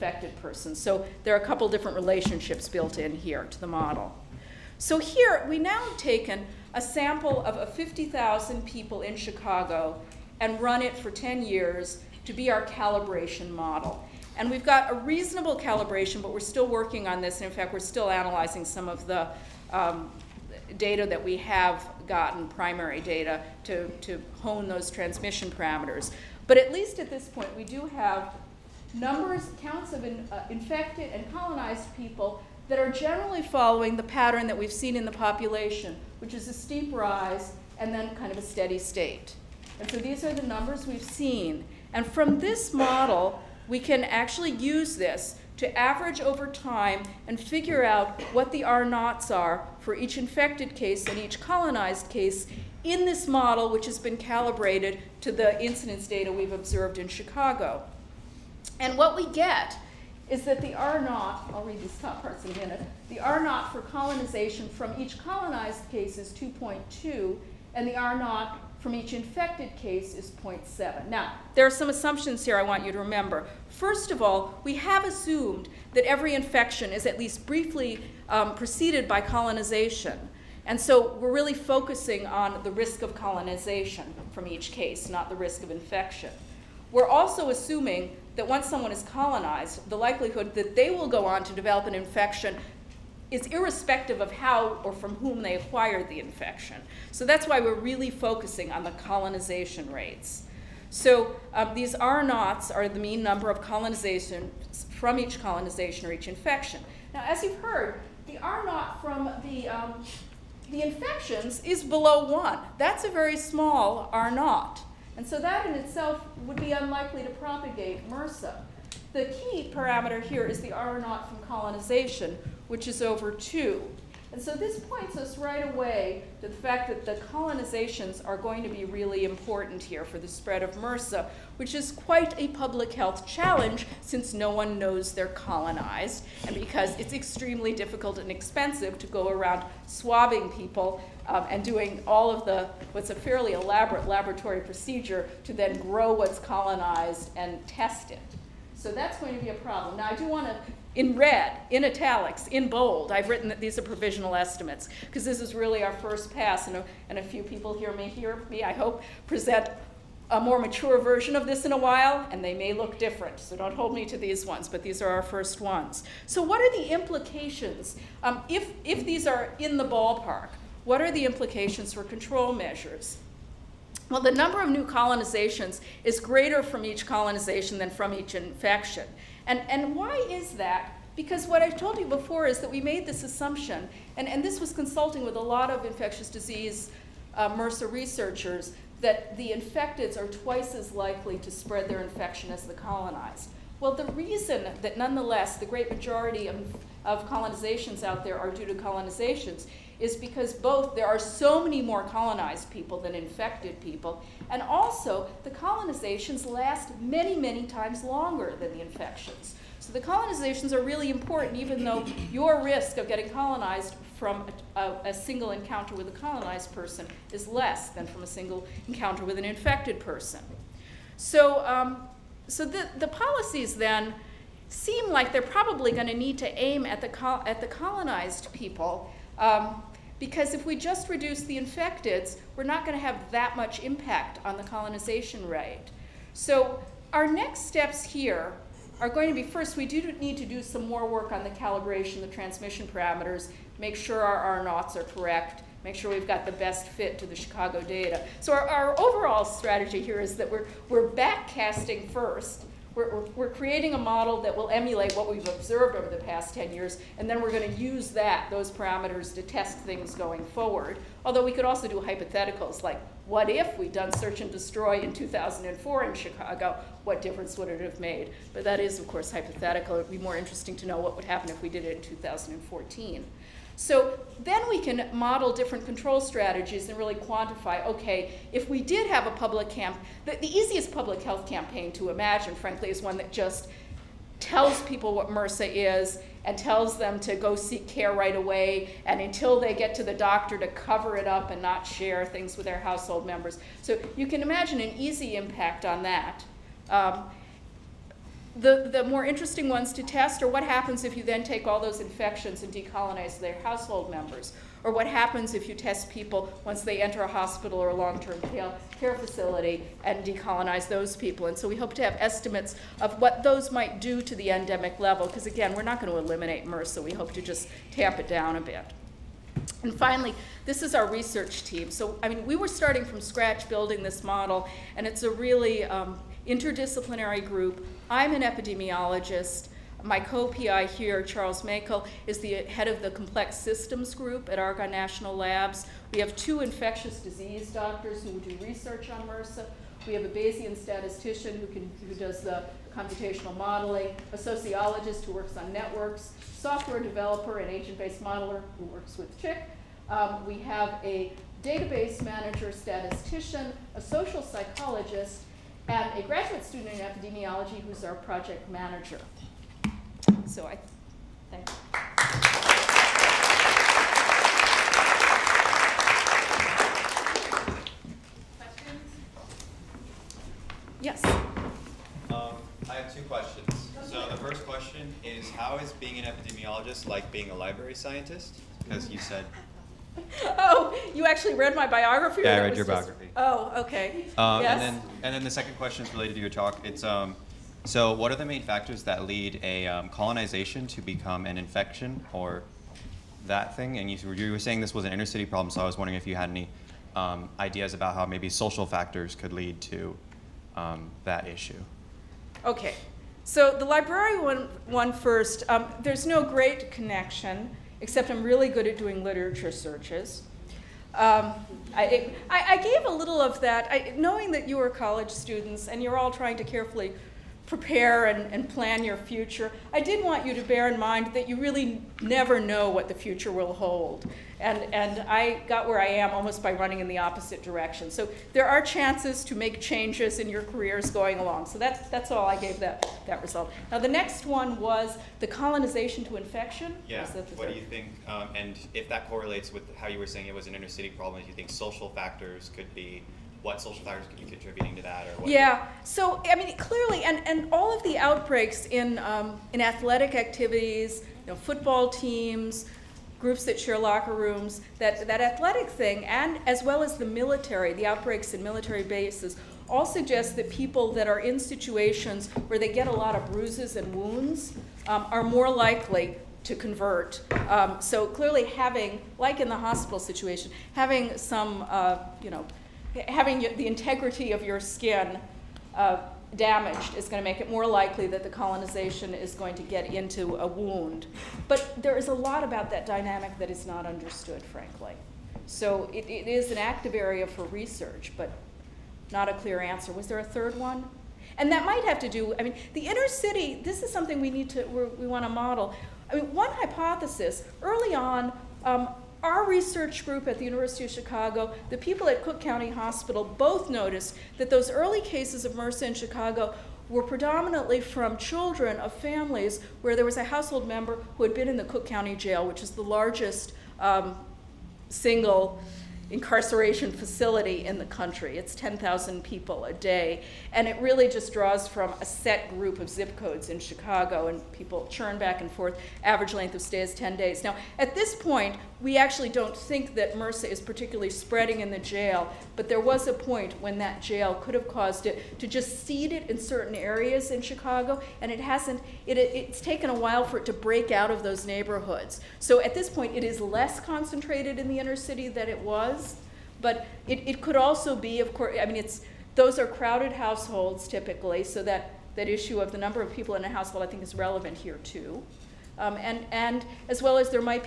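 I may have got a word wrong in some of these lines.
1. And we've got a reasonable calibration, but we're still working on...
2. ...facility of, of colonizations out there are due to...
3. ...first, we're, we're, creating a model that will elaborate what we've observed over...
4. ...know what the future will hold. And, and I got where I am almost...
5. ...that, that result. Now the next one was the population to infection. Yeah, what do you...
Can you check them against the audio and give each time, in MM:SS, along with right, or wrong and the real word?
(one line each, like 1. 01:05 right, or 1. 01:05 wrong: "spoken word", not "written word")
1. 00:14 right
2. 03:15 wrong: "majority", not "facility"
3. 04:12 wrong: "emulate", not "elaborate"
4. 07:02 right
5. 07:12 wrong: "colonization", not "population".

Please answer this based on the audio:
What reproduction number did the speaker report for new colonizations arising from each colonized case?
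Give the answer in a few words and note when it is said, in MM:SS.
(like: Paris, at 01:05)
2.2, at 01:06.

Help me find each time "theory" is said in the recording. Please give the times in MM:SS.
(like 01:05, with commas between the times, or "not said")
not said.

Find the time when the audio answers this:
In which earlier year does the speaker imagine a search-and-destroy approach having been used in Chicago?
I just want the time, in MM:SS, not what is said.
04:25.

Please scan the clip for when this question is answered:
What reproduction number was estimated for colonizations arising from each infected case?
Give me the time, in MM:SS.
01:10.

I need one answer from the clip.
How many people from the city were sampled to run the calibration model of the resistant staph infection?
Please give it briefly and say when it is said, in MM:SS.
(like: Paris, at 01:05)
50,000, at 00:07.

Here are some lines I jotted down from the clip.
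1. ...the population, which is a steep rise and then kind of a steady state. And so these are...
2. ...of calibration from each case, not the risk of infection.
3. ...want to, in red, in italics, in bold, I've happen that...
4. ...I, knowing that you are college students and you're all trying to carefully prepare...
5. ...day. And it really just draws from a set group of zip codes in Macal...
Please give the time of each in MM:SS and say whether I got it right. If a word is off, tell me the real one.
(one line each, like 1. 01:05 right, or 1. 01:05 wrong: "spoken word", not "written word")
1. 00:35 right
2. 01:23 wrong: "colonization", not "calibration"
3. 02:30 wrong: "written", not "happen"
4. 06:53 right
5. 08:39 wrong: "Chicago", not "Macal".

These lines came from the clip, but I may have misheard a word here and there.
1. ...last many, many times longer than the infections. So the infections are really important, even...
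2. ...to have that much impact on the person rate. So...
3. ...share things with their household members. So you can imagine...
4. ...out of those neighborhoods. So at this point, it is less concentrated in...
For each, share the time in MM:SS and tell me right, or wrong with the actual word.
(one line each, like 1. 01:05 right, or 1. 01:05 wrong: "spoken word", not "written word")
1. 03:26 wrong: "colonizations", not "infections"
2. 03:52 wrong: "colonization", not "person"
3. 04:51 right
4. 09:01 right.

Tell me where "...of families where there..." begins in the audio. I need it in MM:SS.
08:28.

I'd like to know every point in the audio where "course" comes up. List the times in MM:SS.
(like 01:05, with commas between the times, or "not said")
04:29, 09:08.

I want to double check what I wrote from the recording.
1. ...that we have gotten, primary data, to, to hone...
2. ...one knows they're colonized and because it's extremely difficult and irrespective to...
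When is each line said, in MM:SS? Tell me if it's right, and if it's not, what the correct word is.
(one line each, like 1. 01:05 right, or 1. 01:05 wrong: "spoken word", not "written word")
1. 00:21 right
2. 02:14 wrong: "expensive", not "irrespective".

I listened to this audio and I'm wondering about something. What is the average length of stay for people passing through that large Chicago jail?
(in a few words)
10 days.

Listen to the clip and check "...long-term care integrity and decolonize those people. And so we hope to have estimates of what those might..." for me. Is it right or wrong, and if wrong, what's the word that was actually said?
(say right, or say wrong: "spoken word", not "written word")
wrong: "facility", not "integrity".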